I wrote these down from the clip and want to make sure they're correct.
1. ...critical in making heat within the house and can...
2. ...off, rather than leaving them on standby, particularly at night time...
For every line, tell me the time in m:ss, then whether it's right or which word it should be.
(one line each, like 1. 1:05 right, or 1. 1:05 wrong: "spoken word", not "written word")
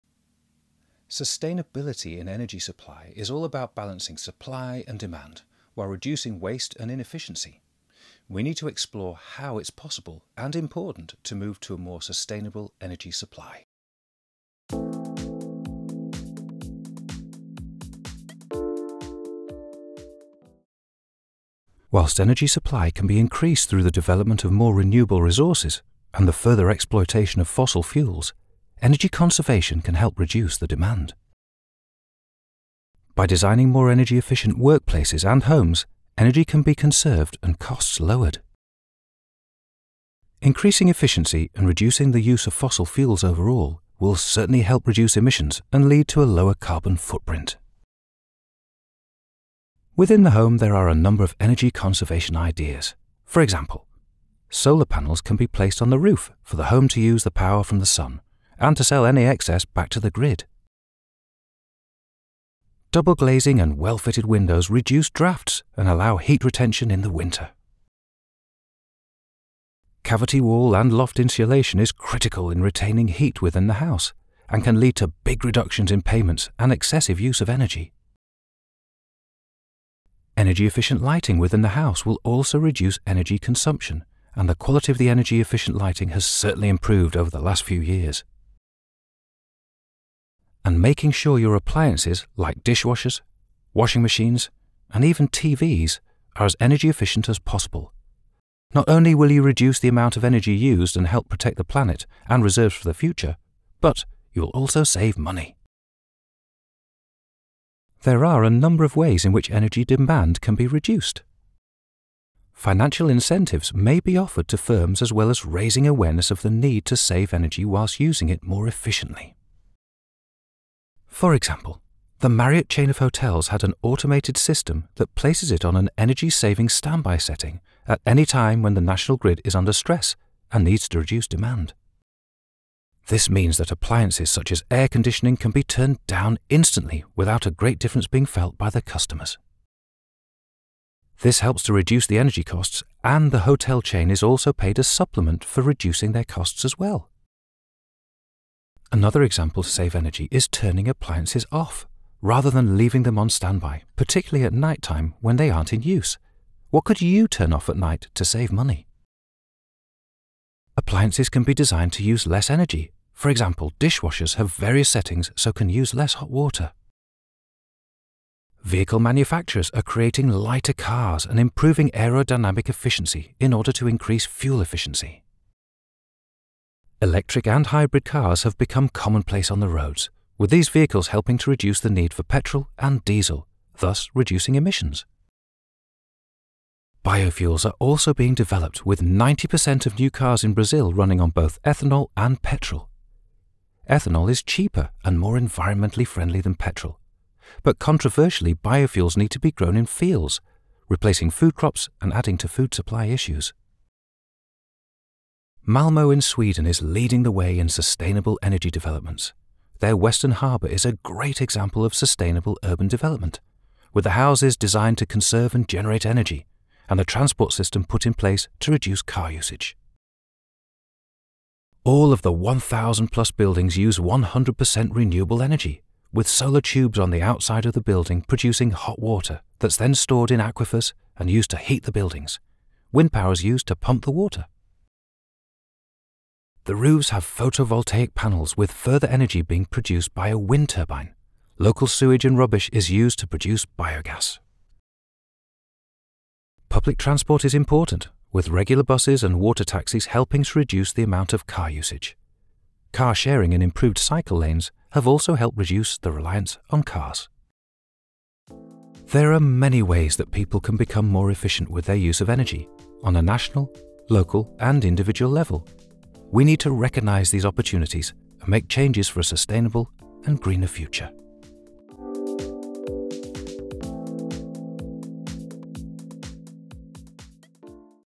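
1. 1:11 wrong: "retaining", not "making"
2. 2:31 right.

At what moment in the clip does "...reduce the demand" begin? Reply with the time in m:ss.
0:30.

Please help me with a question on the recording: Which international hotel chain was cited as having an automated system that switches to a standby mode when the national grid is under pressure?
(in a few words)
Marriott.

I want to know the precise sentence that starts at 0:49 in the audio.
Within the home, there are a number of energy conservation ideas.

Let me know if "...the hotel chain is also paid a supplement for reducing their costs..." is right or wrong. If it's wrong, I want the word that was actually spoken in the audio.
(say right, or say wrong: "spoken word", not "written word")
right.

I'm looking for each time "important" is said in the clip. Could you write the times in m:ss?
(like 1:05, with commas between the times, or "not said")
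0:10, 4:07.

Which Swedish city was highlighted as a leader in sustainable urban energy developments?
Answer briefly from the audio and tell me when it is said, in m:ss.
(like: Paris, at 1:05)
Malmo, at 3:25.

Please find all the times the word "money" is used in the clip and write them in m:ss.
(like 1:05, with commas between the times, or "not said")
1:45, 2:38.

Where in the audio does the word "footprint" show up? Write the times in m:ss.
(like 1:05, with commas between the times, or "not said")
0:46.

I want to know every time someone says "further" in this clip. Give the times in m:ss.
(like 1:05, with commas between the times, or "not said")
0:26, 3:58.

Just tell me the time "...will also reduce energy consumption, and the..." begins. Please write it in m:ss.
1:22.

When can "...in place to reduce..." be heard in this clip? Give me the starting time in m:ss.
3:38.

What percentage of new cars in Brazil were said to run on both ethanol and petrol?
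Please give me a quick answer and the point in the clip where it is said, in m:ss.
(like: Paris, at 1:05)
90%, at 3:09.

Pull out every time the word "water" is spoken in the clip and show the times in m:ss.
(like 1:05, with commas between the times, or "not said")
2:46, 3:48, 3:54, 4:09.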